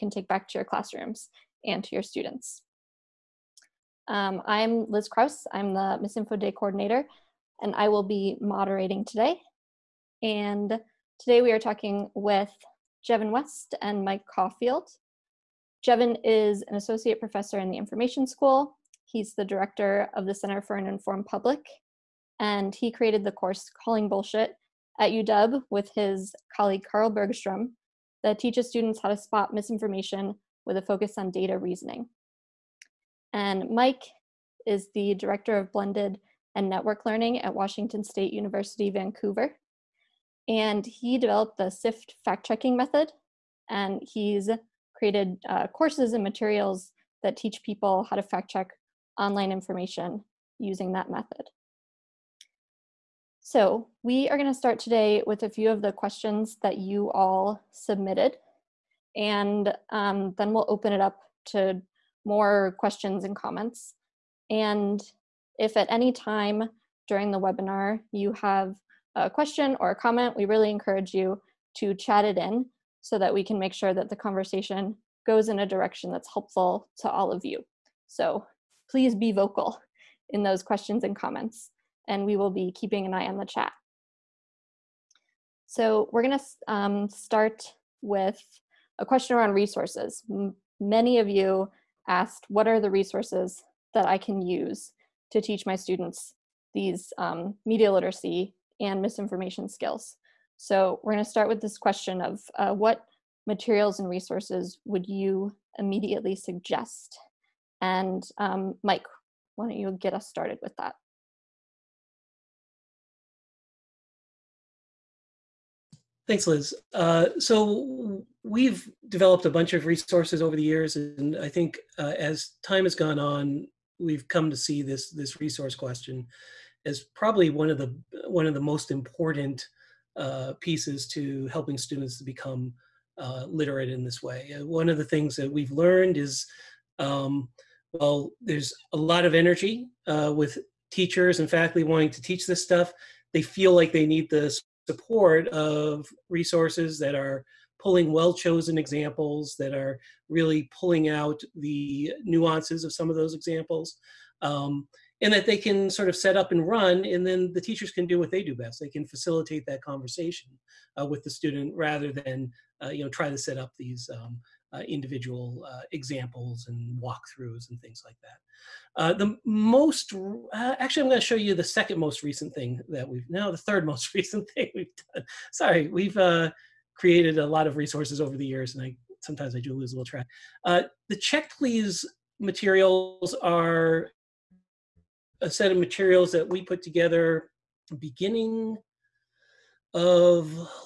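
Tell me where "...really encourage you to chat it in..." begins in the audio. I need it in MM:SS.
01:10.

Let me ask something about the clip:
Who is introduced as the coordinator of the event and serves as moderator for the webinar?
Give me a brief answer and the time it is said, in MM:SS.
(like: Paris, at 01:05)
Liz Kraus, at 00:04.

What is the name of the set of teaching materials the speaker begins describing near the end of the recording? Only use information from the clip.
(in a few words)
Check Please.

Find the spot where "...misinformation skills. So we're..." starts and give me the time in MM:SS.
01:39.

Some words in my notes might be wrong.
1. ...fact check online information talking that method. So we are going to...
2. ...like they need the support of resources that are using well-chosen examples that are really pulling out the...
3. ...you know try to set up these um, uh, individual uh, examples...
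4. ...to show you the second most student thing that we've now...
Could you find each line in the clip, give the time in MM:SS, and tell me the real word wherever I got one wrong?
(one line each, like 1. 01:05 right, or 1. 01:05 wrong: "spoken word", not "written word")
1. 00:48 wrong: "using", not "talking"
2. 02:23 wrong: "pulling", not "using"
3. 02:42 right
4. 02:51 wrong: "recent", not "student".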